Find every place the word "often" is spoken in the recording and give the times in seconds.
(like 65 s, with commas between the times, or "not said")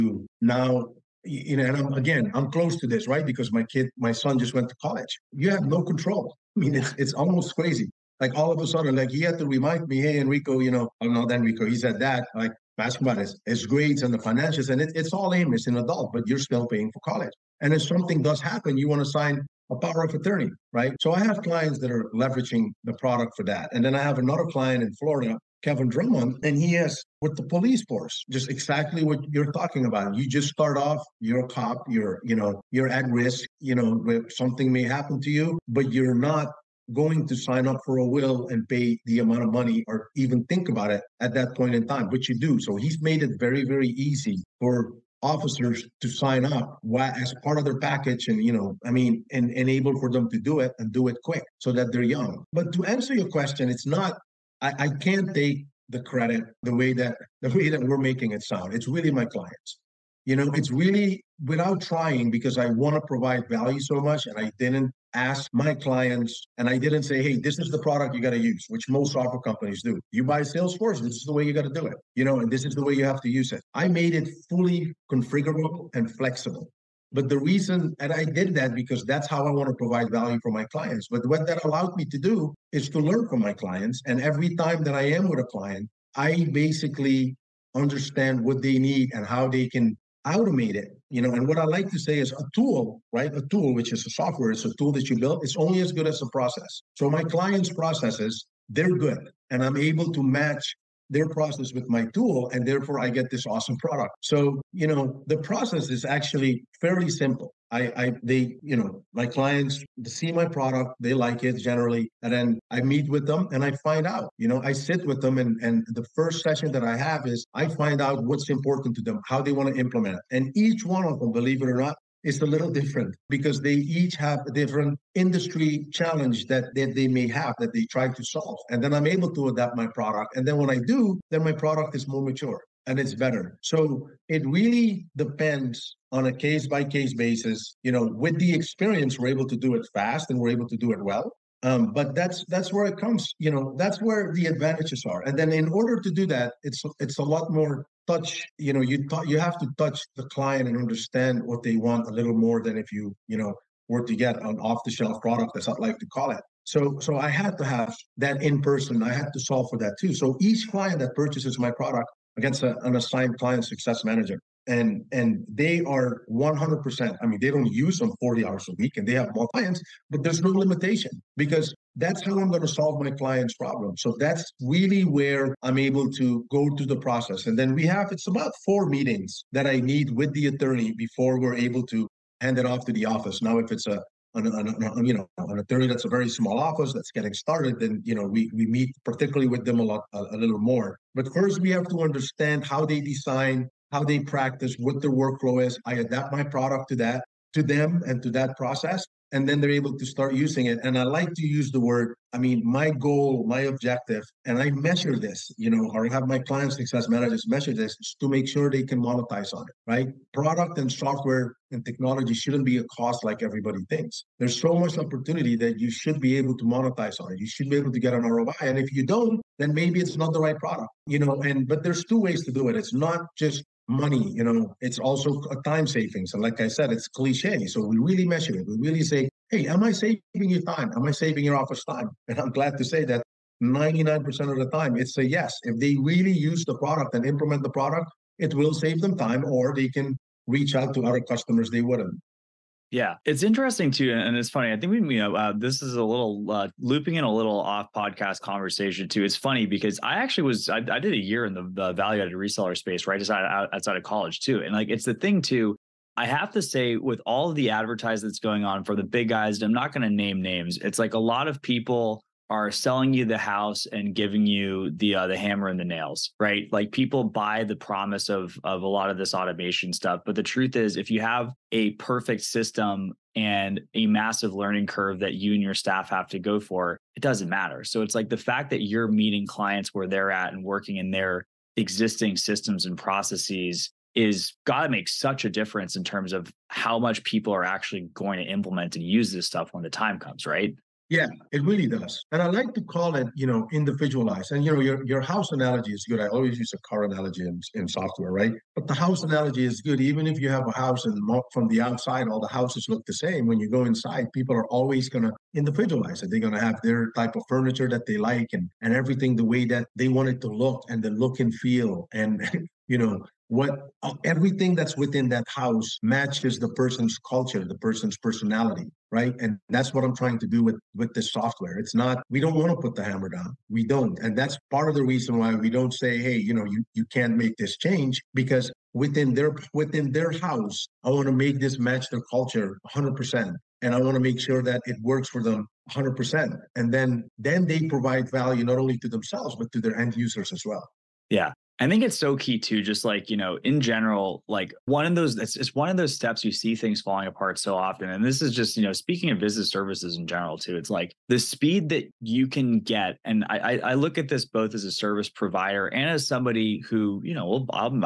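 347 s.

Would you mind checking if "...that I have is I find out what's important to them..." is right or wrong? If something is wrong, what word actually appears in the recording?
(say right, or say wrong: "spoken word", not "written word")
right.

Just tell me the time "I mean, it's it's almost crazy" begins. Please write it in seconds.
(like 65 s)
6 s.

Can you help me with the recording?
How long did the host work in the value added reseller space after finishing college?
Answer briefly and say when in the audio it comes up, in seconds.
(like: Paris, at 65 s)
A year, at 251 s.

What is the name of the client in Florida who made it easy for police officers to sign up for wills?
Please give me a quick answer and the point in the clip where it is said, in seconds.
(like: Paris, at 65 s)
Kevin Drummond, at 25 s.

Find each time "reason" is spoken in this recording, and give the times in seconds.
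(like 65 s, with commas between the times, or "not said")
77 s, 325 s.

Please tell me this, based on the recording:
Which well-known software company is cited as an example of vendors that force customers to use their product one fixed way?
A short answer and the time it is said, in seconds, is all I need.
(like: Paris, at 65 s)
Salesforce, at 70 s.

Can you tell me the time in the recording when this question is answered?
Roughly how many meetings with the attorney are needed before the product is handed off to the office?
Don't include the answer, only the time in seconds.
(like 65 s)
178 s.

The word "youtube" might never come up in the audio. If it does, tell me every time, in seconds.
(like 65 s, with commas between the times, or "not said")
not said.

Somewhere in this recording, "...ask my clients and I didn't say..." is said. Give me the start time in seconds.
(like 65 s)
65 s.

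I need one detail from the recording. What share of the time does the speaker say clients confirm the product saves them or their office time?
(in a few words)
99%.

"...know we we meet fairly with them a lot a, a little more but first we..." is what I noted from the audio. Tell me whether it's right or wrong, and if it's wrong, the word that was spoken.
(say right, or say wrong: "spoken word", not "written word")
wrong: "particularly", not "fairly".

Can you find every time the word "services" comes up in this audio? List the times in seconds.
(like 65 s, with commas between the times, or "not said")
349 s, 354 s.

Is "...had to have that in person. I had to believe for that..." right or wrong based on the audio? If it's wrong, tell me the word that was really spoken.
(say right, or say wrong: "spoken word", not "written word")
wrong: "solve", not "believe".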